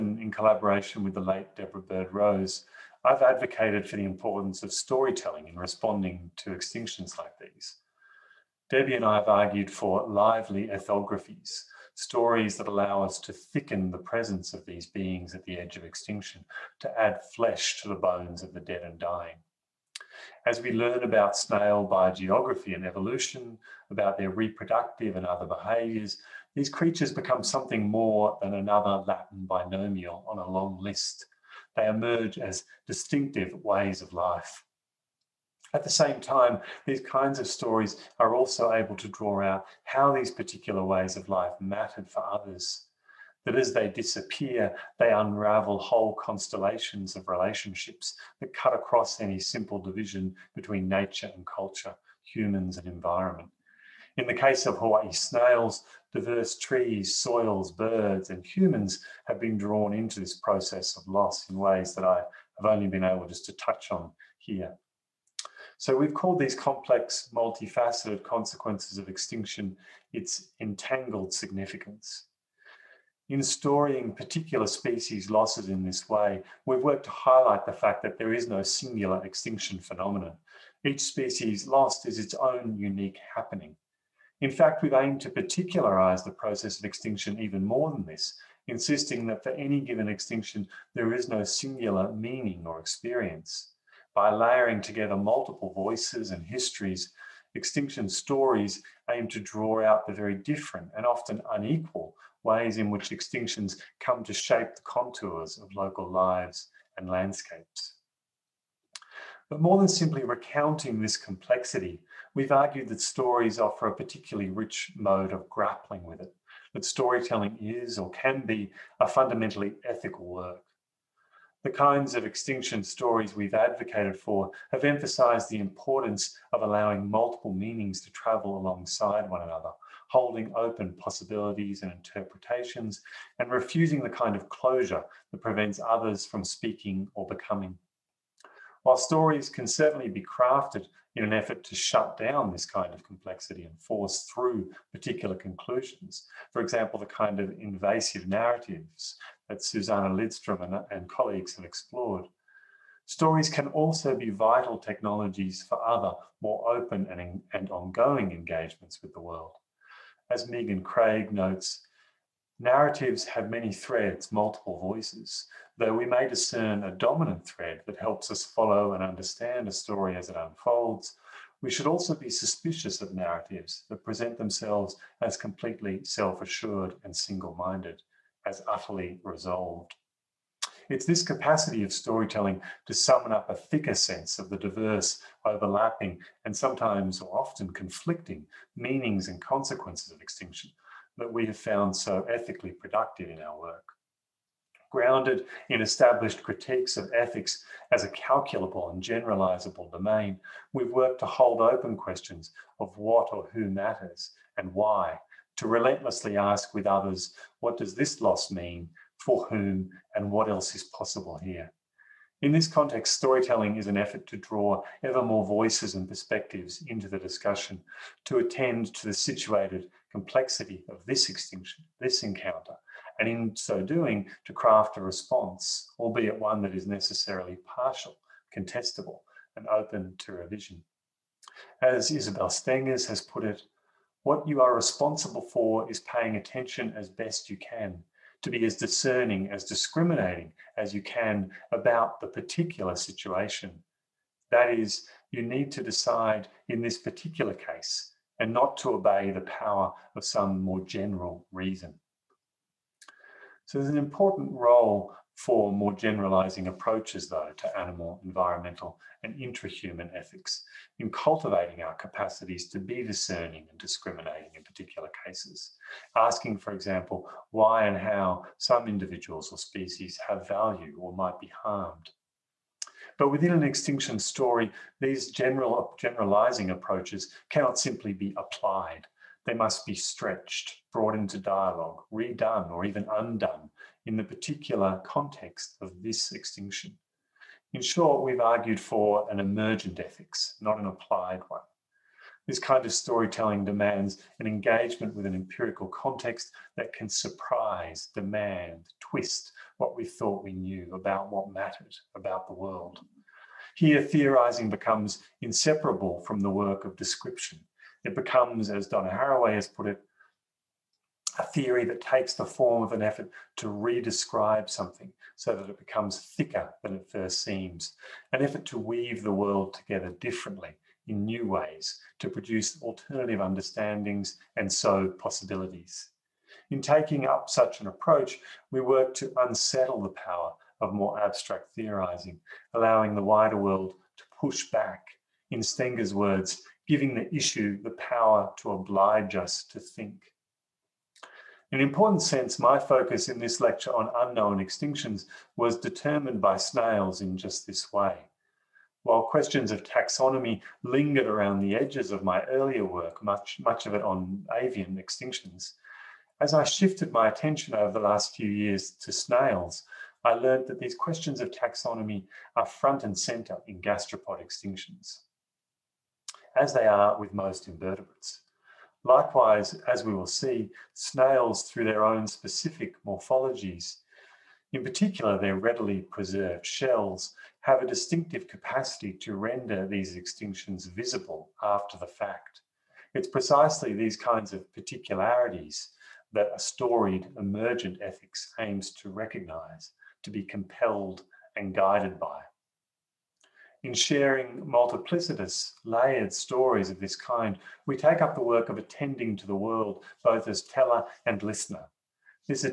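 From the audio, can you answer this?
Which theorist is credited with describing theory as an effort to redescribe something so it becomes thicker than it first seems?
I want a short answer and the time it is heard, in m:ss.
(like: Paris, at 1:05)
Donna Haraway, at 5:08.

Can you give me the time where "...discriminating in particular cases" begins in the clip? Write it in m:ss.
4:23.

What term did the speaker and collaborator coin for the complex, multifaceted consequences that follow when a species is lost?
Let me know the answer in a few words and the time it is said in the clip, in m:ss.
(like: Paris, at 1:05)
entangled significance, at 1:10.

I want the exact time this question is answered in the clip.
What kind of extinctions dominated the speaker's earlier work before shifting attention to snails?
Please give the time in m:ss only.
5:54.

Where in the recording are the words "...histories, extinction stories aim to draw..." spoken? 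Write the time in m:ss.
1:36.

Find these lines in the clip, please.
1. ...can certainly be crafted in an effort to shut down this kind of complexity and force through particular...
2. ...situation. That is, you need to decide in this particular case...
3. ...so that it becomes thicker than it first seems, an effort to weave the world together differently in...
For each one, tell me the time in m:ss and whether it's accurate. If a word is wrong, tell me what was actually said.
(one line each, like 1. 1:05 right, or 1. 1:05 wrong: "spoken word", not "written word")
1. 2:19 right
2. 4:02 right
3. 5:15 right.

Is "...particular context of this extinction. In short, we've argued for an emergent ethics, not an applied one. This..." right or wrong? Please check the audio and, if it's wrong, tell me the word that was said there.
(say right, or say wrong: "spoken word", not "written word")
right.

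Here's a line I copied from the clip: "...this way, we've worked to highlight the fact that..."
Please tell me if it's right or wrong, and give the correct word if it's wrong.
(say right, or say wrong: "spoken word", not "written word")
right.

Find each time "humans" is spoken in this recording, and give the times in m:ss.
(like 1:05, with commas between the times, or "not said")
0:52, 0:58, 4:19.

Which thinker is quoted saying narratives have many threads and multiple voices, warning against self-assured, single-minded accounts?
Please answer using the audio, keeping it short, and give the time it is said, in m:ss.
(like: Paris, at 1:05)
Megan Craig, at 2:40.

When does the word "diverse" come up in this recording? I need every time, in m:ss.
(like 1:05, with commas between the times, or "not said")
0:56, 3:04.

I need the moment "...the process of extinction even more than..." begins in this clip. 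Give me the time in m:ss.
1:26.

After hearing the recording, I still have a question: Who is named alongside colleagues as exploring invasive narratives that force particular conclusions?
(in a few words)
Susanna Lidstrom.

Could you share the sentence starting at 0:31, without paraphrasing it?
They emerge as distinctive ways of life.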